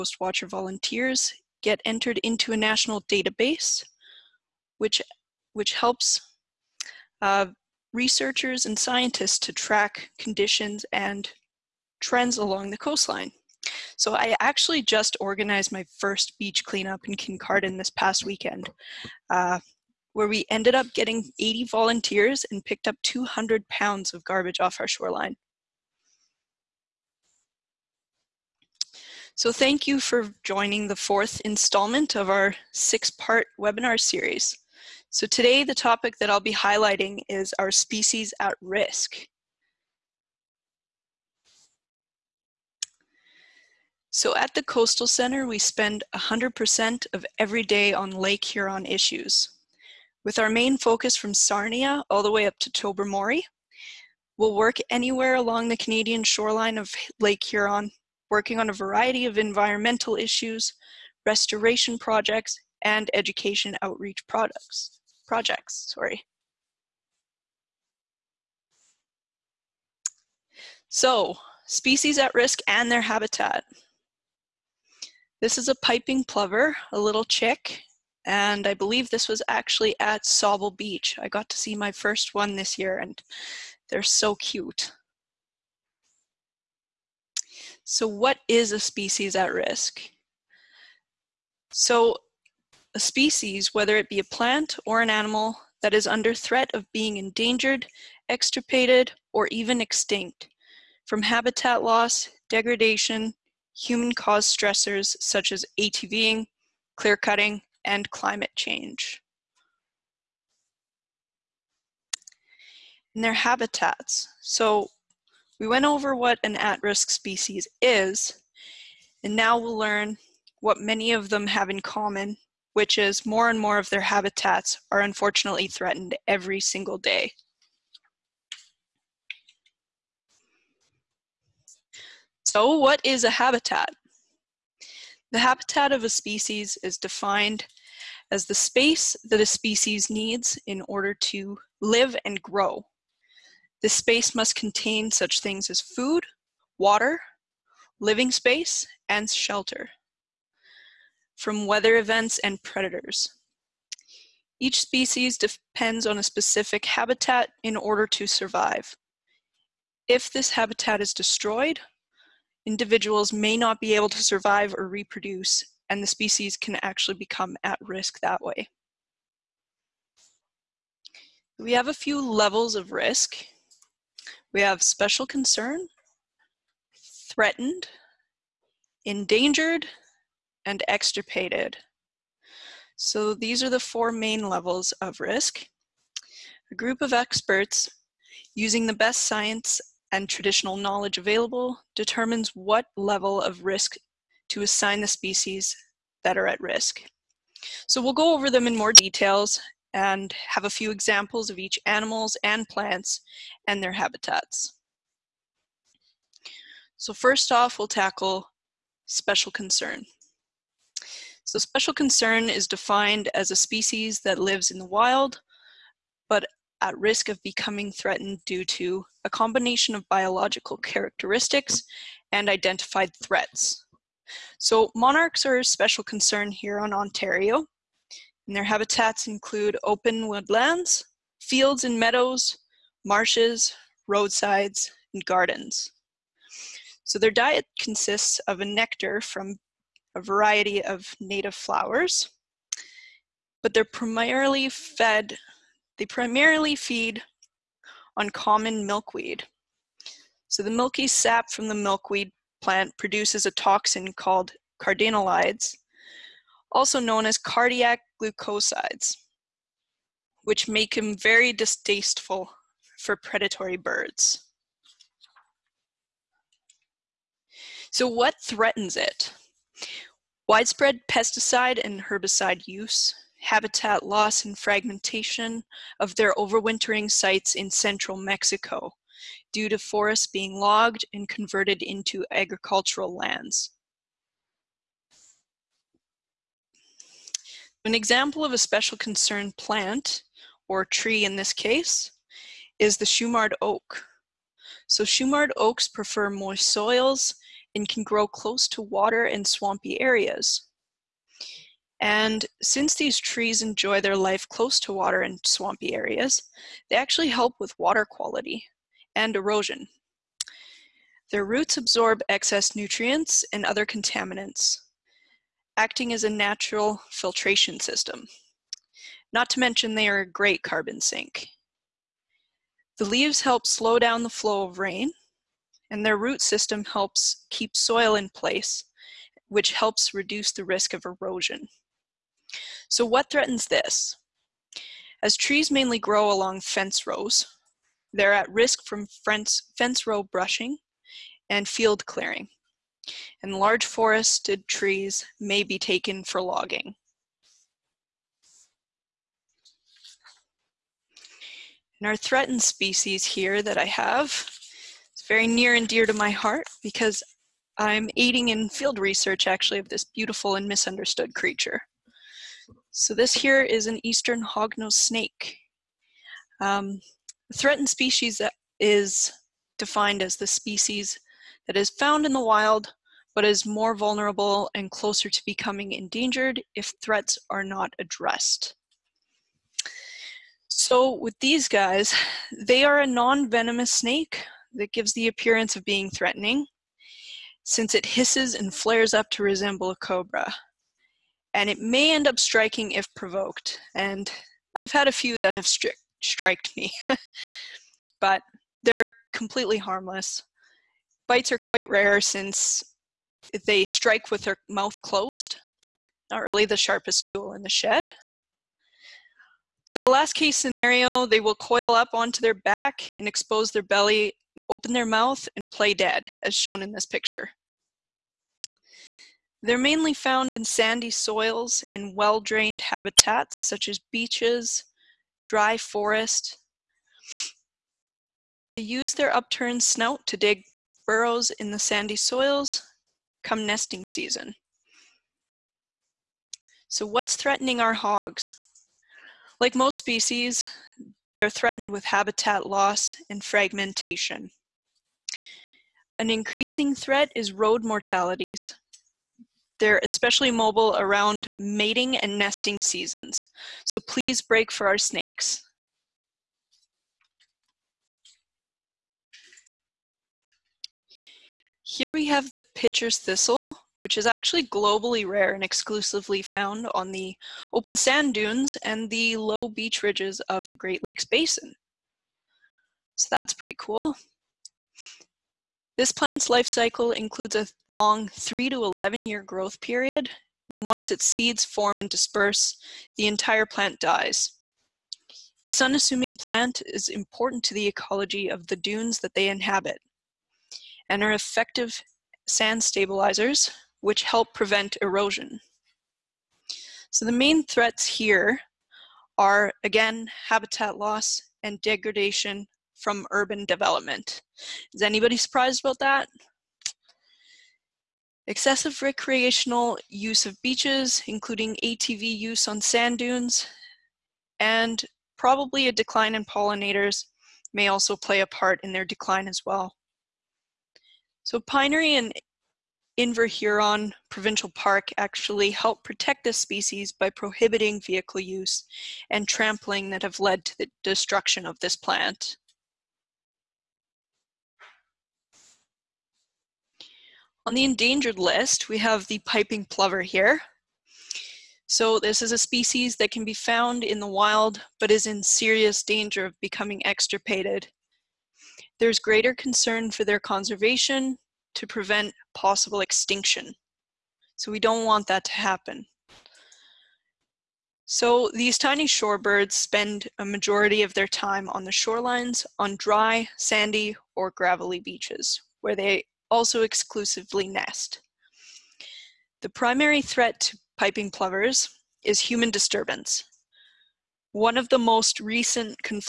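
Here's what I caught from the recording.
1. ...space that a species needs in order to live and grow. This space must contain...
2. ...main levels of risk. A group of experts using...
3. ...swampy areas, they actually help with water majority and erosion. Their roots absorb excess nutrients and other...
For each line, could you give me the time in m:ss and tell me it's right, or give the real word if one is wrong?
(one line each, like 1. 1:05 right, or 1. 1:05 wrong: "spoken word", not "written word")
1. 2:18 right
2. 3:04 right
3. 5:05 wrong: "quality", not "majority".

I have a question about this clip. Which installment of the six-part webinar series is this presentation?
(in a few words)
Fourth.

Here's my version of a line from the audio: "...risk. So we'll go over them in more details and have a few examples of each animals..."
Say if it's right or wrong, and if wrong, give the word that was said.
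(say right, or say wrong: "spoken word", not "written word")
right.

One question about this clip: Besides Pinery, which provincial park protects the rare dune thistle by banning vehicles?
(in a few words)
Inverhuron.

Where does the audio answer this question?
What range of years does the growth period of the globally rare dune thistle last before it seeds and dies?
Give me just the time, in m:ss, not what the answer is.
7:58.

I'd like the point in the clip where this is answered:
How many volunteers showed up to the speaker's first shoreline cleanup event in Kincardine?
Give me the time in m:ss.
0:21.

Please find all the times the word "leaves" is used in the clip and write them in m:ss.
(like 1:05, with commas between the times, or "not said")
5:23.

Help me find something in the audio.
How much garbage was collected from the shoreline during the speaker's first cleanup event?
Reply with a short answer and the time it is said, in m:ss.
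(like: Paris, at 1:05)
200 pounds, at 0:23.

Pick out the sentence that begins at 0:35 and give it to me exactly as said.
So today the topic that I'll be highlighting is our species at risk.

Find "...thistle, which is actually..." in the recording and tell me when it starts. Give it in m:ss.
7:43.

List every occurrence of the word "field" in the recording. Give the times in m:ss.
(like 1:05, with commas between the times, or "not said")
3:51, 5:41, 5:58.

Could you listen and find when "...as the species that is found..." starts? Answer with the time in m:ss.
6:10.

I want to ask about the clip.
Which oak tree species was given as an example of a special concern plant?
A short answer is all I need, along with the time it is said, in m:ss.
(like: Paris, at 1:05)
Shumard oak, at 4:53.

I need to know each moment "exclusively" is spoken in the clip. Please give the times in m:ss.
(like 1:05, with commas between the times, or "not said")
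7:45, 9:26.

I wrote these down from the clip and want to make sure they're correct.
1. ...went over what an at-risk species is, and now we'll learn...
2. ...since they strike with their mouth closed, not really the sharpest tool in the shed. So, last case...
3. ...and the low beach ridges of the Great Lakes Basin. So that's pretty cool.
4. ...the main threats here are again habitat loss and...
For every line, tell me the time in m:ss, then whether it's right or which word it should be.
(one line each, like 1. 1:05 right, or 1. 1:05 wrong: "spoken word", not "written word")
1. 1:55 right
2. 6:42 right
3. 7:48 right
4. 8:17 right.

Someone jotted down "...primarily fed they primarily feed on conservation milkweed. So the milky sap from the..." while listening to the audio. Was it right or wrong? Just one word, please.
wrong.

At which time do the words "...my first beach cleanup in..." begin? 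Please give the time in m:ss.
0:15.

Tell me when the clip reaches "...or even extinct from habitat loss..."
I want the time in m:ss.
1:39.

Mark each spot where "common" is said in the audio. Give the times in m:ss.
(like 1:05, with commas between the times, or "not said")
2:01, 4:08.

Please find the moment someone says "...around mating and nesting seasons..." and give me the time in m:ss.
7:30.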